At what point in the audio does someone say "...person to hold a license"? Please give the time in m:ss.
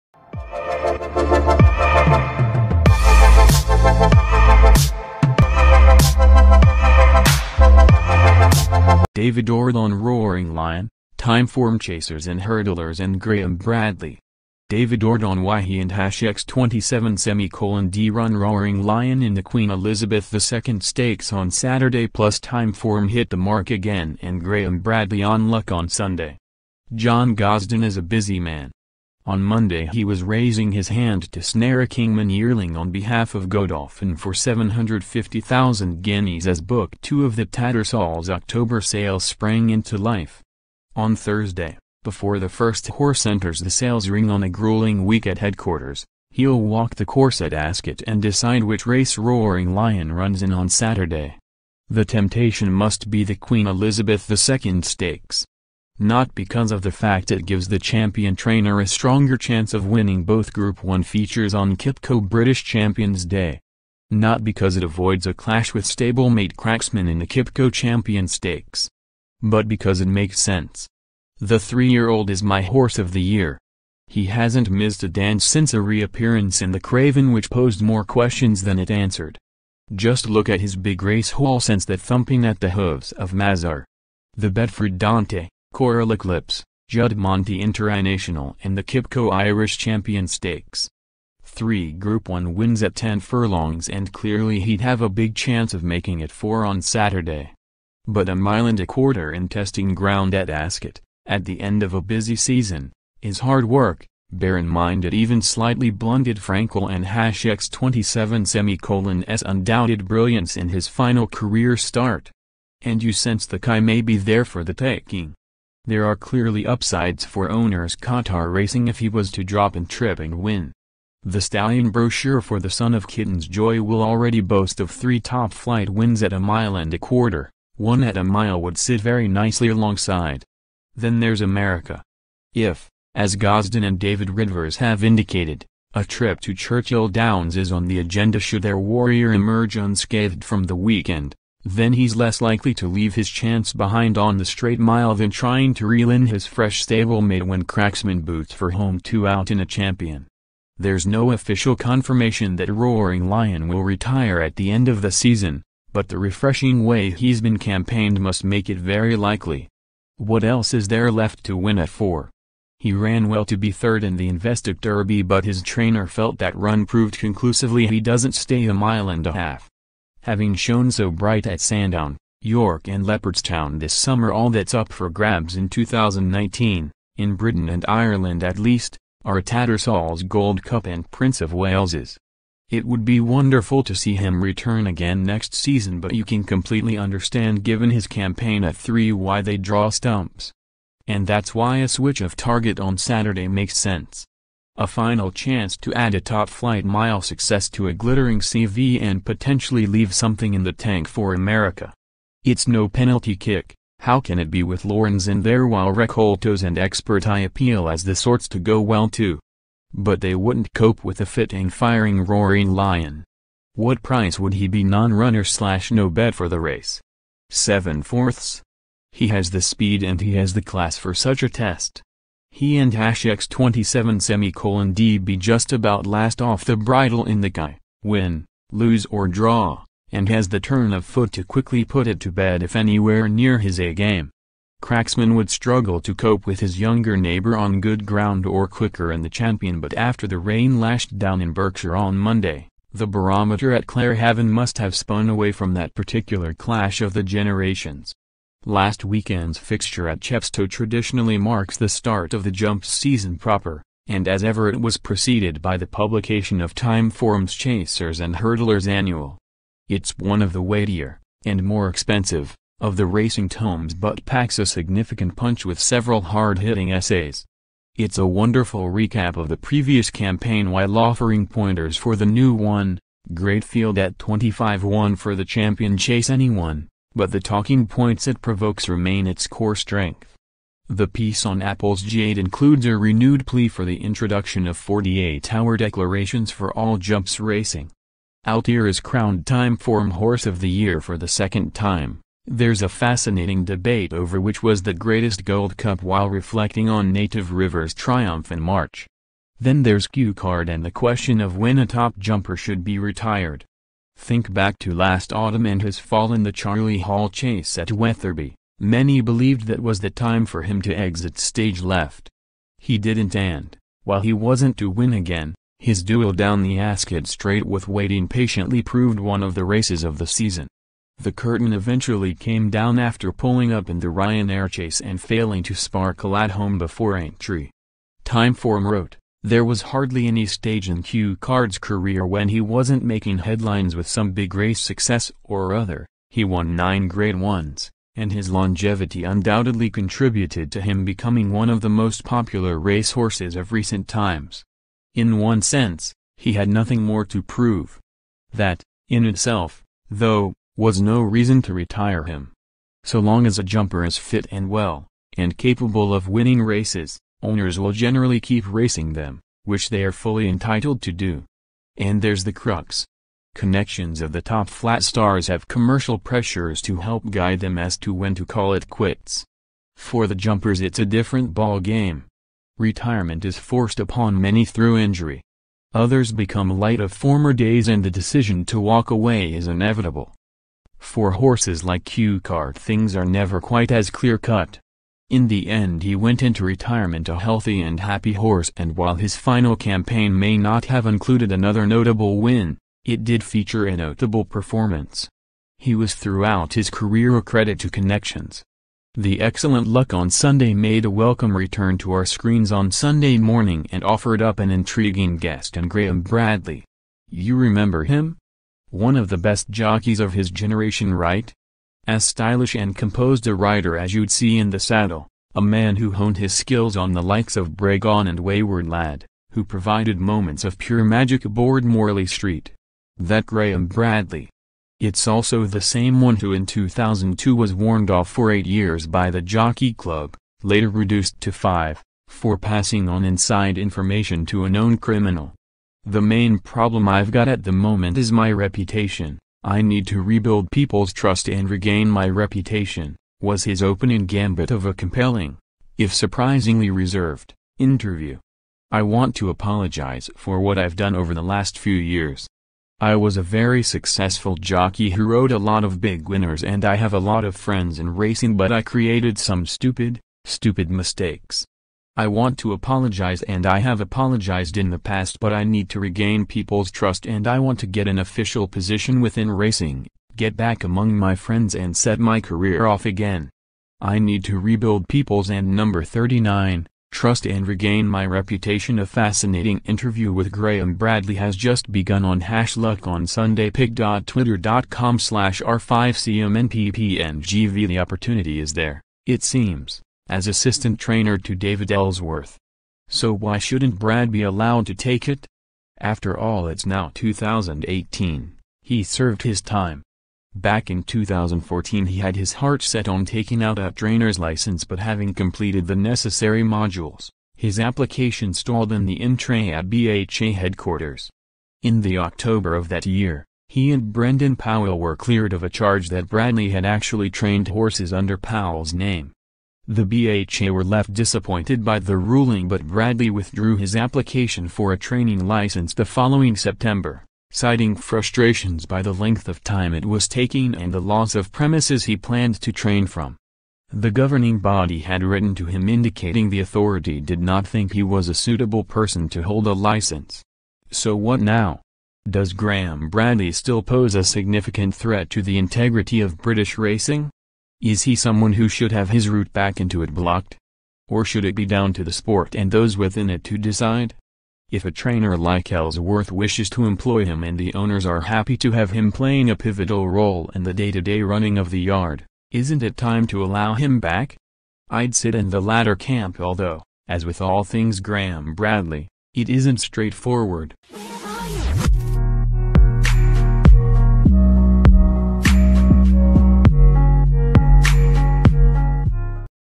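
8:58.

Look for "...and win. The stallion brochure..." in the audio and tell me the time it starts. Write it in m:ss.
2:00.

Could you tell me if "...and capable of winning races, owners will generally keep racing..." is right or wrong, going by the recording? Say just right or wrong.
right.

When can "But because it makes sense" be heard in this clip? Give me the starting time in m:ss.
1:09.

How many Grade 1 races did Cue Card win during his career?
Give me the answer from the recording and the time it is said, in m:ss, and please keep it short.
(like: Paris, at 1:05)
9, at 5:36.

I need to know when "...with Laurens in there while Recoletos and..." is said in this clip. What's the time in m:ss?
3:24.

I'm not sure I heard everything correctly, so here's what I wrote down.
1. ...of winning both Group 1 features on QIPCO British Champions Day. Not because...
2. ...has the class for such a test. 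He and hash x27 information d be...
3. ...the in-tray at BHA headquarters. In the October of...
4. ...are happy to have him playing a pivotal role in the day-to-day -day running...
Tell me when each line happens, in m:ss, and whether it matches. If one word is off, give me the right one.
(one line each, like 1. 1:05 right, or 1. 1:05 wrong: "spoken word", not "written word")
1. 0:59 right
2. 3:40 wrong: "semicolon", not "information"
3. 8:29 right
4. 9:18 right.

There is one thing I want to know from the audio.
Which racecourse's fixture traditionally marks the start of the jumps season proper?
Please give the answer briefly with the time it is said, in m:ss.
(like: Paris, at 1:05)
Chepstow, at 4:10.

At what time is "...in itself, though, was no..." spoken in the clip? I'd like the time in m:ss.
5:49.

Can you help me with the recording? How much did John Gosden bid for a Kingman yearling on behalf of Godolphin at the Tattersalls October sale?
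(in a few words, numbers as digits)
750,000 guineas.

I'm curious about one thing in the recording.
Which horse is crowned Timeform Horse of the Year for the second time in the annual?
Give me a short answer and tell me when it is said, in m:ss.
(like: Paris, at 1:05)
Altior, at 4:48.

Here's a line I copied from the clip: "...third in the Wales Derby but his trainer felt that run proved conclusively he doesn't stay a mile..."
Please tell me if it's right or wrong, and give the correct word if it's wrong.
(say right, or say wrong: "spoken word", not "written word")
wrong: "Investec", not "Wales".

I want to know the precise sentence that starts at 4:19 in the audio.
It's one of the weightier, and more expensive, of the racing tomes but packs a significant punch with several hard-hitting essays.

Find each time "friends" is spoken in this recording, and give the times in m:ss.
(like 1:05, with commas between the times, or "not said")
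7:37, 7:51.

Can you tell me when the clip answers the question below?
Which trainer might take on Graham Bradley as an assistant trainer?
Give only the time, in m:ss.
8:11.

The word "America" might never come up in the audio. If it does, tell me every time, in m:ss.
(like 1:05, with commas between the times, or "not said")
2:11, 3:21.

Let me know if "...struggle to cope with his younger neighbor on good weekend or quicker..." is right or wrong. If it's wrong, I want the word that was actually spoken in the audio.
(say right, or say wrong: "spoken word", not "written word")
wrong: "ground", not "weekend".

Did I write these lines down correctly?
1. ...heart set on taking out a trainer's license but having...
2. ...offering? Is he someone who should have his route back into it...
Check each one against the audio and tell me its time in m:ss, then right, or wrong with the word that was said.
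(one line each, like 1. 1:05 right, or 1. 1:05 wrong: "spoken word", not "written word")
1. 8:22 right
2. 9:06 wrong: "racing", not "offering".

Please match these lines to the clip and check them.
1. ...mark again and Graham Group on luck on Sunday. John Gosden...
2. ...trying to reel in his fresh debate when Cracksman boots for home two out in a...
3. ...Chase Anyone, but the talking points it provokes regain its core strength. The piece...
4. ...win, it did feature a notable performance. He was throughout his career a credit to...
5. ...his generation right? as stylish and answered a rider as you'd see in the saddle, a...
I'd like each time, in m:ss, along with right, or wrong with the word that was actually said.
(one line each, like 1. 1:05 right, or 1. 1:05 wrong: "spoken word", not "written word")
1. 0:23 wrong: "Bradley", not "Group"
2. 2:25 wrong: "stablemate", not "debate"
3. 4:35 wrong: "remain", not "regain"
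4. 6:32 right
5. 6:50 wrong: "composed", not "answered".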